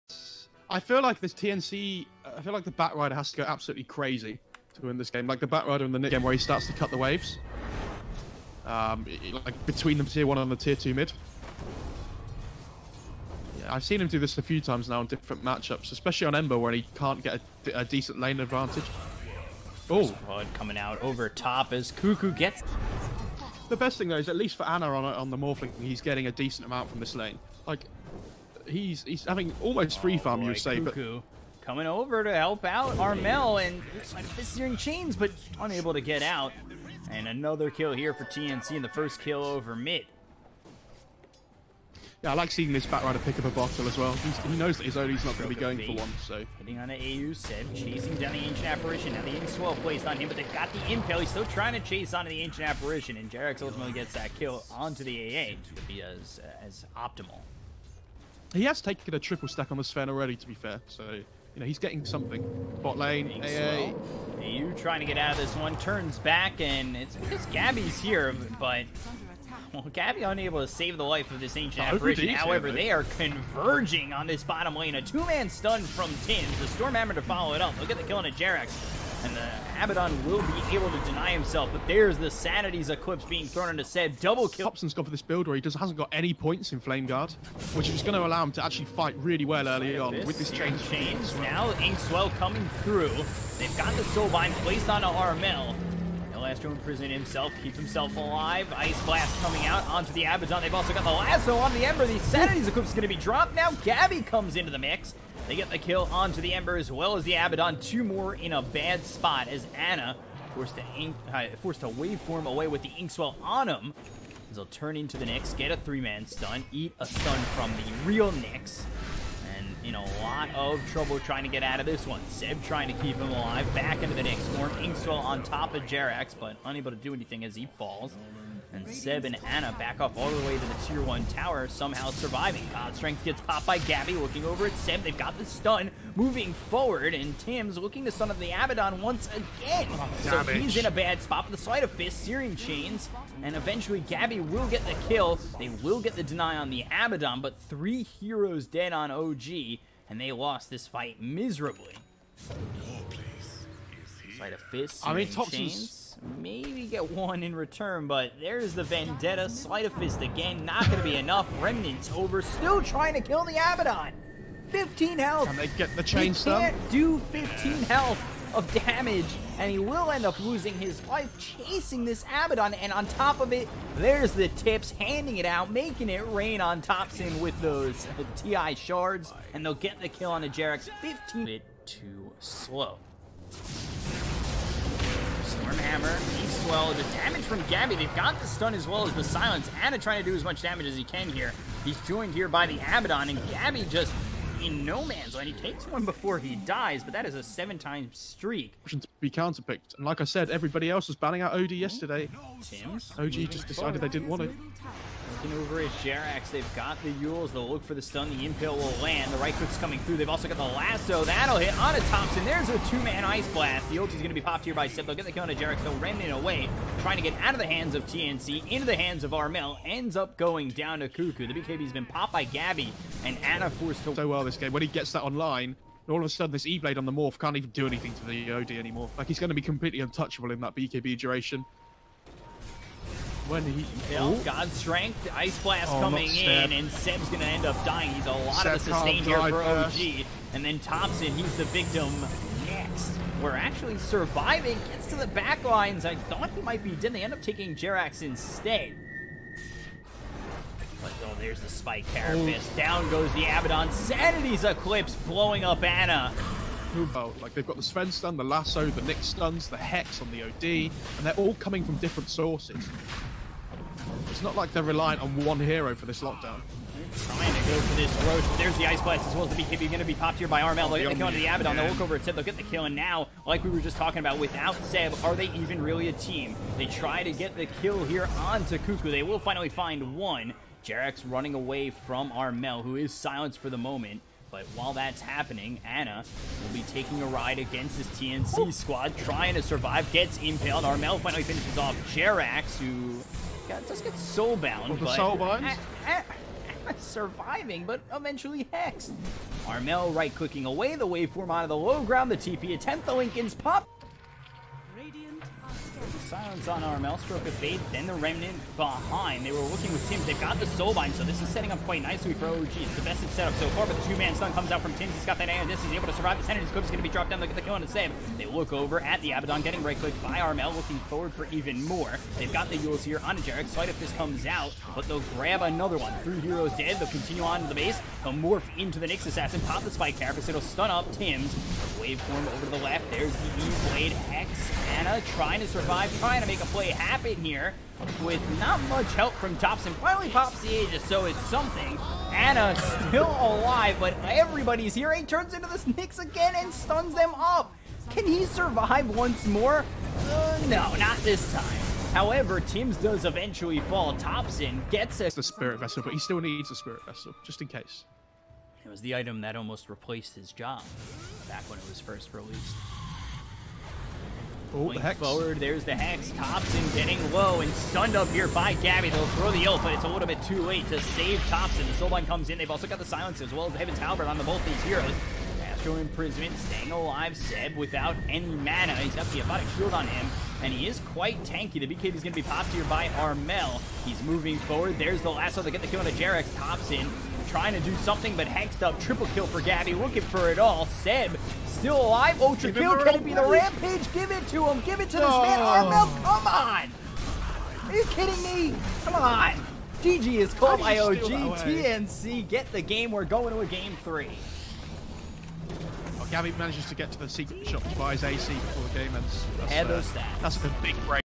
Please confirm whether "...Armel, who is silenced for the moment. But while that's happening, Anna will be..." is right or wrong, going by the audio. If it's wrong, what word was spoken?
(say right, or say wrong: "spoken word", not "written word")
right.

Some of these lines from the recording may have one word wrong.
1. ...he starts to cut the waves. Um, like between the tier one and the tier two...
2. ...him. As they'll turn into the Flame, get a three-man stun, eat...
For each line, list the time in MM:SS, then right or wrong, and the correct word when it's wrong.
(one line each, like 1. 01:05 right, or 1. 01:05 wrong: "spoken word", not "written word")
1. 00:06 right
2. 01:53 wrong: "Nyx", not "Flame".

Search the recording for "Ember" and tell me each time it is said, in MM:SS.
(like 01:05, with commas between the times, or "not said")
00:16, 01:41, 01:46.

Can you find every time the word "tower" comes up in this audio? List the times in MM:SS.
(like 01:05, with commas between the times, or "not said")
02:11.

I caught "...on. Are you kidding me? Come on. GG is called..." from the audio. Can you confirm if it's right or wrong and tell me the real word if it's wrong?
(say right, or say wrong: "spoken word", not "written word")
right.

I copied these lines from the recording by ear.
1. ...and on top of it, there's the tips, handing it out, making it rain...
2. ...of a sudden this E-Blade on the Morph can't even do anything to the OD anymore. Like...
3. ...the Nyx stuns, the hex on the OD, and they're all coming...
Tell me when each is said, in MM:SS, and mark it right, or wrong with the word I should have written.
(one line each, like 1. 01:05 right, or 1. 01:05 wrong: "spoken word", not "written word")
1. 02:52 right
2. 03:46 right
3. 04:18 right.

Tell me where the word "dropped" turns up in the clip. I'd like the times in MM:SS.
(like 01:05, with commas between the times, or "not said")
01:43, 05:17.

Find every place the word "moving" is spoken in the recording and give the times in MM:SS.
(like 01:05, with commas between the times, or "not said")
02:16, 06:24.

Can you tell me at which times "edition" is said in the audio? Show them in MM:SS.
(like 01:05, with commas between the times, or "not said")
not said.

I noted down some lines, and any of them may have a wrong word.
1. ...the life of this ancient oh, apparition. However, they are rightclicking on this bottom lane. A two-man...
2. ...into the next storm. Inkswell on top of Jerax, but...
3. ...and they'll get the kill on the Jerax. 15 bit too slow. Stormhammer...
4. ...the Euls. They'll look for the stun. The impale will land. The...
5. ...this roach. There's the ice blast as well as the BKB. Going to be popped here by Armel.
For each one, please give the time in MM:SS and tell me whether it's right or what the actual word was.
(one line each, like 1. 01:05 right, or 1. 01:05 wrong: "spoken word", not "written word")
1. 01:10 wrong: "converging", not "rightclicking"
2. 02:04 right
3. 02:59 right
4. 03:27 right
5. 04:27 right.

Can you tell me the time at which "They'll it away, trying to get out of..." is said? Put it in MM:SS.
03:35.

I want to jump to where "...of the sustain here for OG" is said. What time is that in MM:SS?
03:58.